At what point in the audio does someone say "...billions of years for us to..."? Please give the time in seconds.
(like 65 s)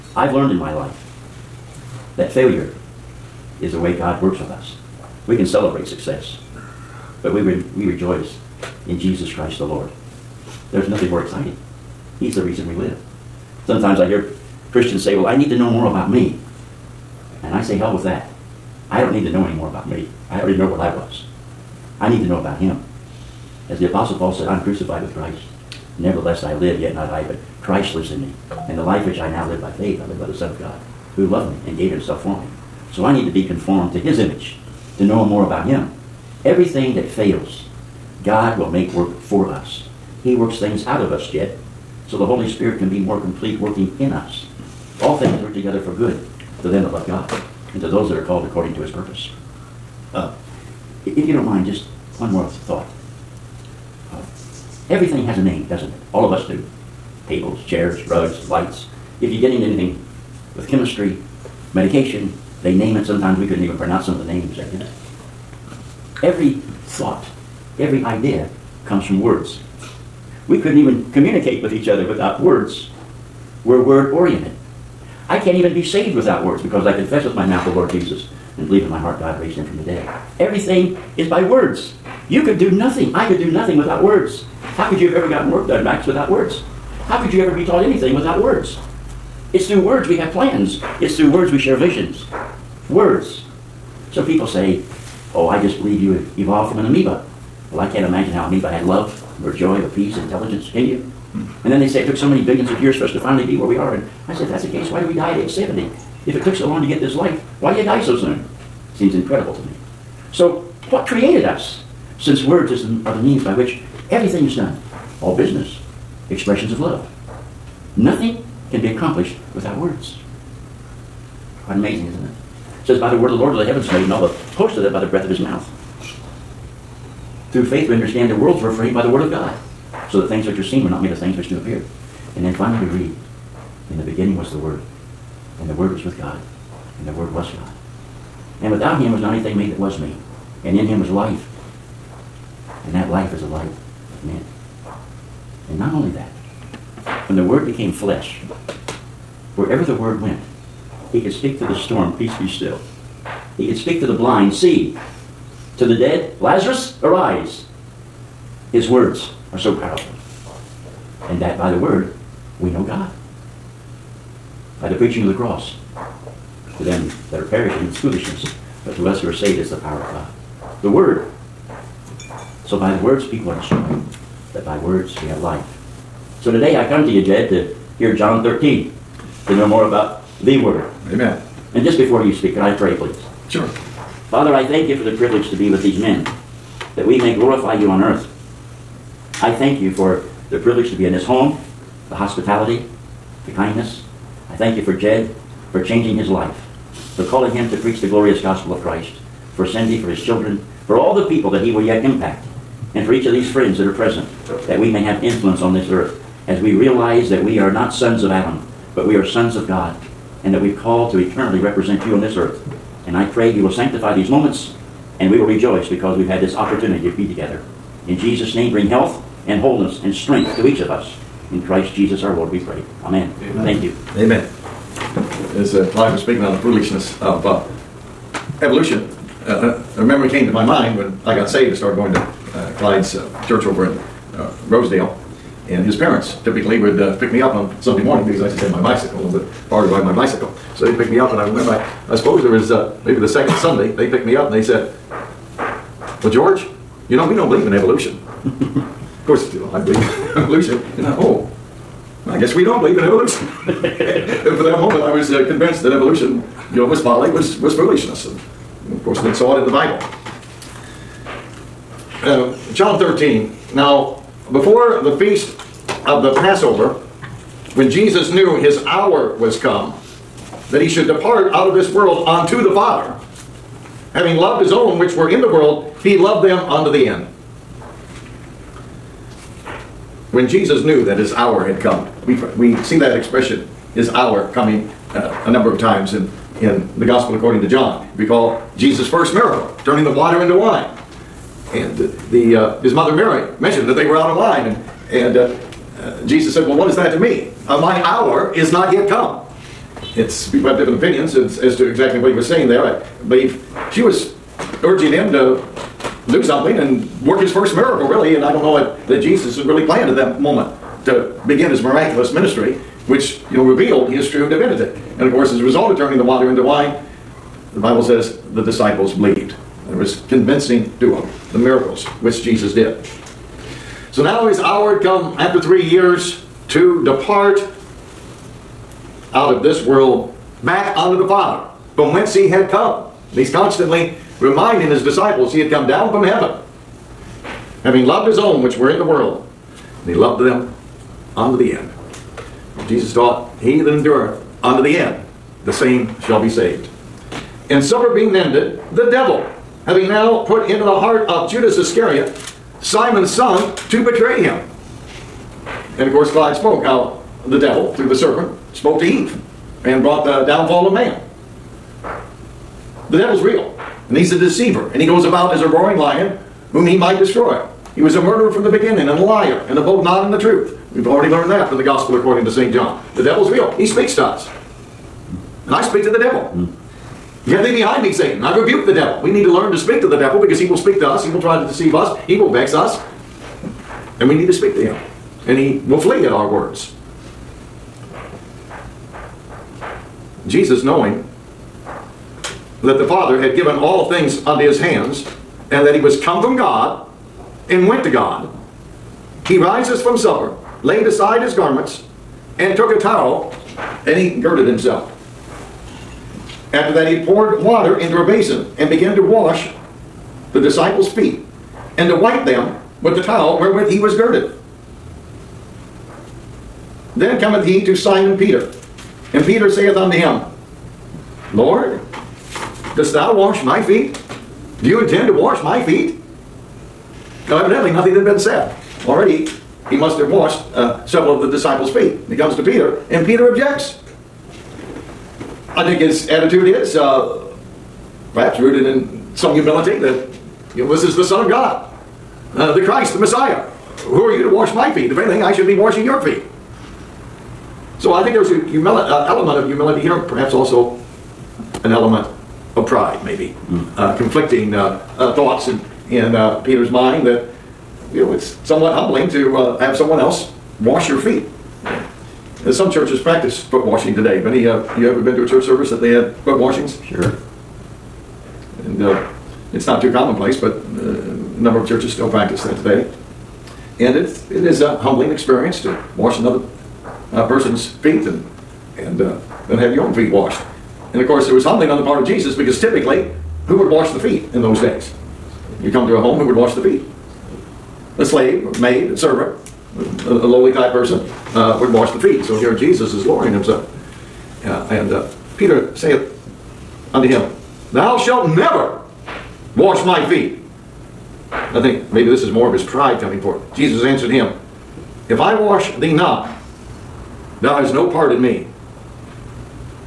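102 s.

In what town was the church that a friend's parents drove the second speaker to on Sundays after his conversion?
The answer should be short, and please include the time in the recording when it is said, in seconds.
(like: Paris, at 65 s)
Rosedale, at 234 s.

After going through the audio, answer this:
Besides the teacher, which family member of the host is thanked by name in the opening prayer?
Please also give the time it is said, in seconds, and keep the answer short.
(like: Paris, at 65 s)
Cindy, at 199 s.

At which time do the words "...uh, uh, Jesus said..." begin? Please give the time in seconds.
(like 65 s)
295 s.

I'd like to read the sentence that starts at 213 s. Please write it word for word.
And I pray you will sanctify these moments, and we will rejoice because we've had this opportunity to be together.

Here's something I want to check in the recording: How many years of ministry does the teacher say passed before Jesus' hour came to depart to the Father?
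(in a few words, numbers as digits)
3.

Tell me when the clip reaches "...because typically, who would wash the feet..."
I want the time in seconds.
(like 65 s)
482 s.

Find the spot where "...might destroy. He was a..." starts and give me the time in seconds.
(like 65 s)
366 s.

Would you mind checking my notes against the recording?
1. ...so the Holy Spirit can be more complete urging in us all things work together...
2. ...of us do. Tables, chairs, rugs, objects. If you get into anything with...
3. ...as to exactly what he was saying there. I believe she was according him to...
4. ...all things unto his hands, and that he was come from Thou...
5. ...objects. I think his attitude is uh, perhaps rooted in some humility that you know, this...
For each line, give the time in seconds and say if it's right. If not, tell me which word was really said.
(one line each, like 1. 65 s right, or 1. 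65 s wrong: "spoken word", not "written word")
1. 42 s wrong: "working", not "urging"
2. 56 s wrong: "lights", not "objects"
3. 301 s wrong: "urging", not "according"
4. 393 s wrong: "God", not "Thou"
5. 433 s right.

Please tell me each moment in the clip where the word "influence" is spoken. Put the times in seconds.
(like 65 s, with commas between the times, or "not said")
205 s.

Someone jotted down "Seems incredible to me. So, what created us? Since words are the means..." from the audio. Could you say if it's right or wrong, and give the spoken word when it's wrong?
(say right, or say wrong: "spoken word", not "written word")
right.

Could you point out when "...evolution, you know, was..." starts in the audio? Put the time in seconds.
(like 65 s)
255 s.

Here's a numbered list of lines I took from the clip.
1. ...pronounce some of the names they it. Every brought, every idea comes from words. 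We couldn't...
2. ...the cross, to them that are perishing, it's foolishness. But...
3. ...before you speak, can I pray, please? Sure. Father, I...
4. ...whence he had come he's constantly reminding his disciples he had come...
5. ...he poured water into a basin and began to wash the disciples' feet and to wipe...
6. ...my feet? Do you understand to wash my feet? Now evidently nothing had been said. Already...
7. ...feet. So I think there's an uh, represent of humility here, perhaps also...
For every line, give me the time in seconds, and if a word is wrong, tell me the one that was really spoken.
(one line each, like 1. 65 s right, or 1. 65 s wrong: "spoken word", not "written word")
1. 63 s wrong: "thought", not "brought"
2. 165 s right
3. 181 s right
4. 332 s right
5. 407 s right
6. 423 s wrong: "intend", not "understand"
7. 446 s wrong: "element", not "represent".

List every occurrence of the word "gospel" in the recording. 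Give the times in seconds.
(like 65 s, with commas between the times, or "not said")
198 s, 287 s, 371 s.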